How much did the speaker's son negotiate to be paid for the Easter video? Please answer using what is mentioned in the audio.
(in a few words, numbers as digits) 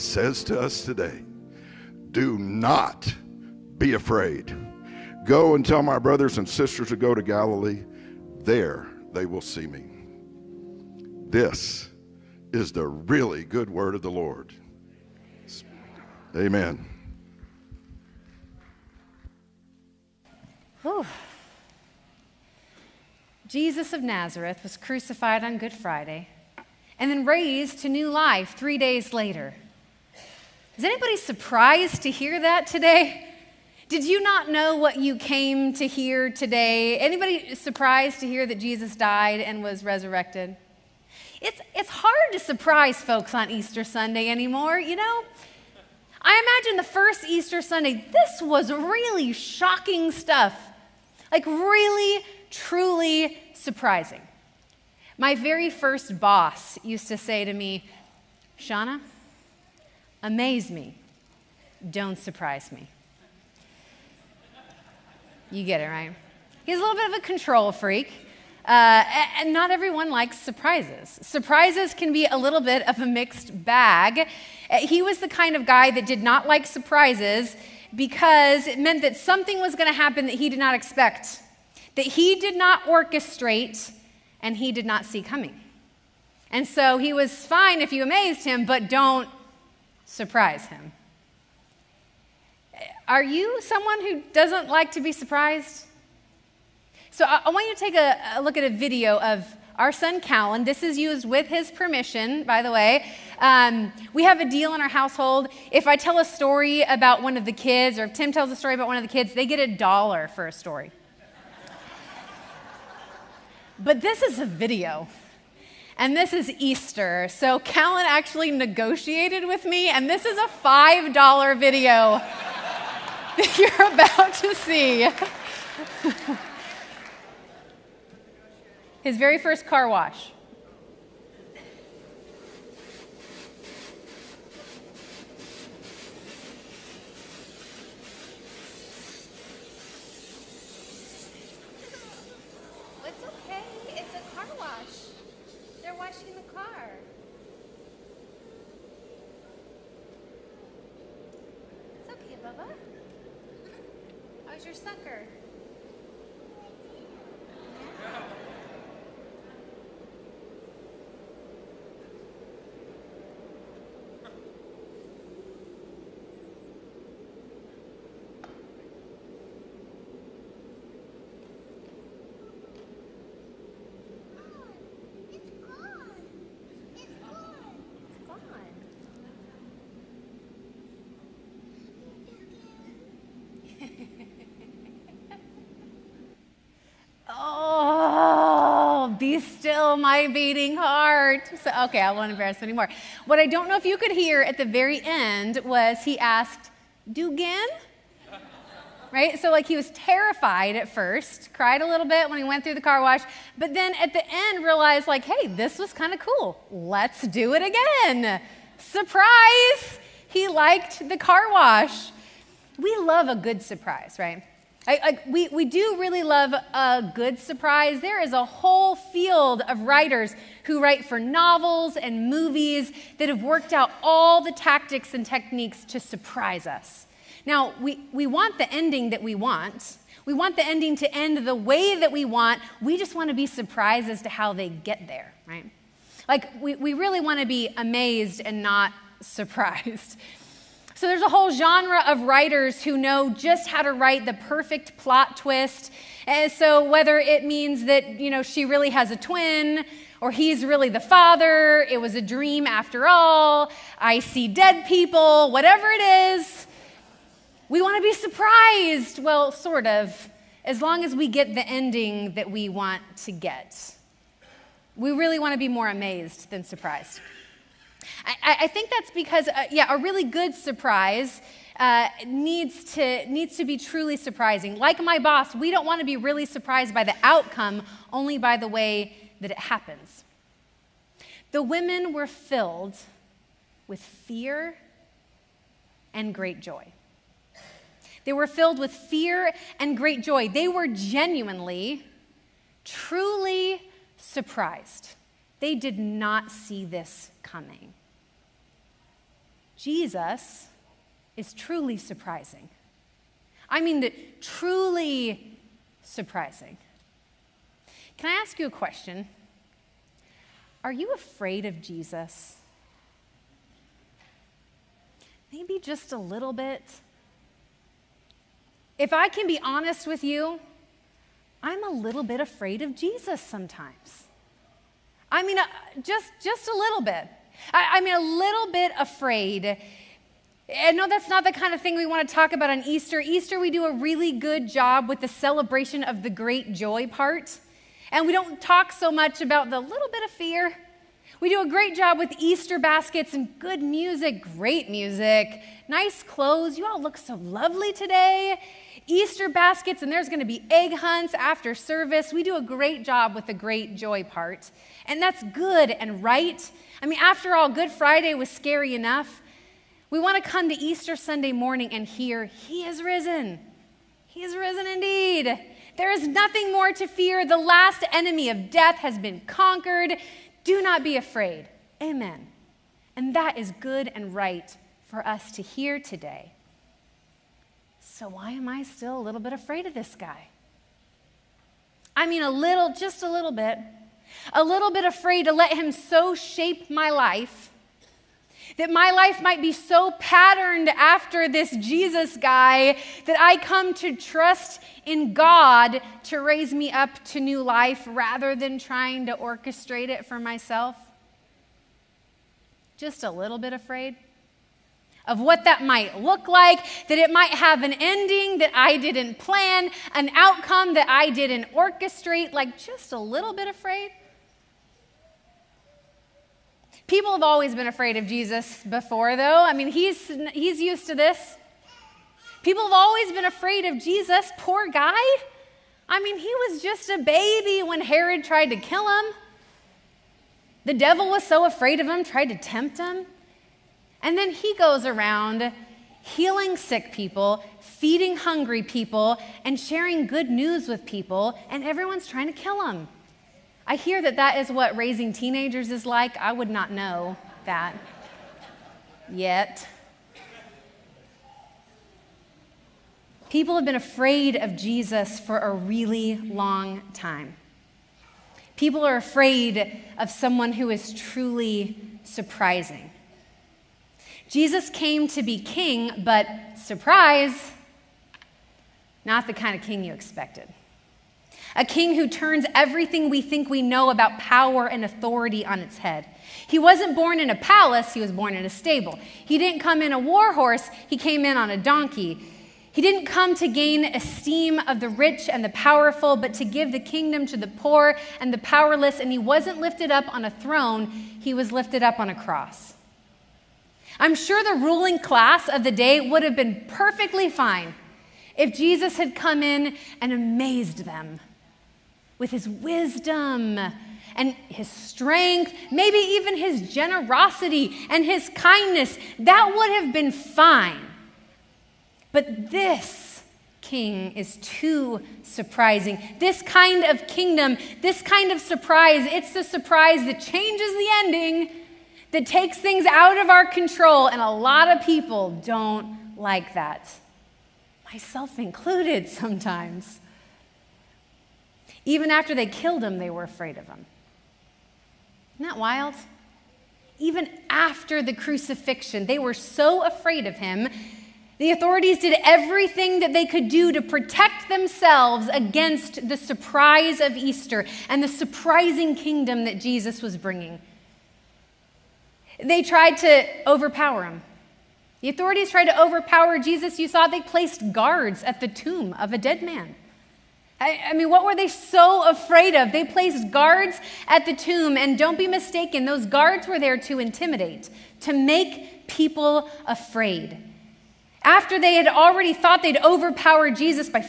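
$5.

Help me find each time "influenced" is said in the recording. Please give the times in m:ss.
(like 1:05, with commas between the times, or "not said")
not said.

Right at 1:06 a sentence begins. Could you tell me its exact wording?
He's a little bit of a control freak.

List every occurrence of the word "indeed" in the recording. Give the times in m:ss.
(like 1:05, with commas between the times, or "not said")
6:04.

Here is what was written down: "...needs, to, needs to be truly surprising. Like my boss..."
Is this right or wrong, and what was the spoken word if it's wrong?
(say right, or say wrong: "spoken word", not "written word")
right.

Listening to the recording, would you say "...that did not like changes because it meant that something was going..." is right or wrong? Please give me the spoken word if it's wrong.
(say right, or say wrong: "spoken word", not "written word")
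wrong: "surprises", not "changes".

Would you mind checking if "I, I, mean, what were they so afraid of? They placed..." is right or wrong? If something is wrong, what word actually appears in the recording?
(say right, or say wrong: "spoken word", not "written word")
right.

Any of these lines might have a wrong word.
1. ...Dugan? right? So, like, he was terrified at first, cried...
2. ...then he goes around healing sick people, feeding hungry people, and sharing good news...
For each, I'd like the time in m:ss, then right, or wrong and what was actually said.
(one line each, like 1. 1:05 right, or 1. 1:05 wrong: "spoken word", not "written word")
1. 3:17 right
2. 7:14 right.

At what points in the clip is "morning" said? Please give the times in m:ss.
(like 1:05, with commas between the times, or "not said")
6:01.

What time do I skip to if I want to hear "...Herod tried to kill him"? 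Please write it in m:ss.
7:08.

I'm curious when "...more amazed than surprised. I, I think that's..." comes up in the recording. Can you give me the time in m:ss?
4:25.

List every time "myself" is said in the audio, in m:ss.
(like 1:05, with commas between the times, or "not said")
6:40, 8:48.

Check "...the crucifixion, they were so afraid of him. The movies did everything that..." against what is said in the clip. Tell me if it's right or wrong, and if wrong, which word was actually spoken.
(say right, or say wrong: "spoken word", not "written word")
wrong: "authorities", not "movies".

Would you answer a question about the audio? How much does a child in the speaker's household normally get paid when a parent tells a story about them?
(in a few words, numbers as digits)
a dollar.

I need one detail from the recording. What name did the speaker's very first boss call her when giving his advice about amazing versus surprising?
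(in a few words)
Shauna.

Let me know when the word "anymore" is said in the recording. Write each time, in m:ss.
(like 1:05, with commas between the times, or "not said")
0:44, 3:12.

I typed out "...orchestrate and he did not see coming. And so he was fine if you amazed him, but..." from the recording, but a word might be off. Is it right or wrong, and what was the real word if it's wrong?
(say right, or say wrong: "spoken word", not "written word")
right.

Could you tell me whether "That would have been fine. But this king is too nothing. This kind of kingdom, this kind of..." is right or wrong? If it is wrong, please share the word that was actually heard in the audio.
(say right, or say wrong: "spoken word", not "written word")
wrong: "surprising", not "nothing".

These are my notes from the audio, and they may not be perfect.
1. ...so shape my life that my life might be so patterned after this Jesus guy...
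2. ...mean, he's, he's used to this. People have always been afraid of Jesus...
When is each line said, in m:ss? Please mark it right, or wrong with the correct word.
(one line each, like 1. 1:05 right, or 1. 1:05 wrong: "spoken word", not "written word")
1. 6:25 right
2. 6:59 right.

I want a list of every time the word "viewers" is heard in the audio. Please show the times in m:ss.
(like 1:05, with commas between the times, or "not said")
not said.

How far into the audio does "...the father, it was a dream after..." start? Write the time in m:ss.
4:10.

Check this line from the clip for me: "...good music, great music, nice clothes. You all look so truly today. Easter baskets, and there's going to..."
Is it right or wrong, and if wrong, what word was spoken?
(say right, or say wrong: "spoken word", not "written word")
wrong: "lovely", not "truly".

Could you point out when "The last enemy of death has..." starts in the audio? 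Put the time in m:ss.
6:07.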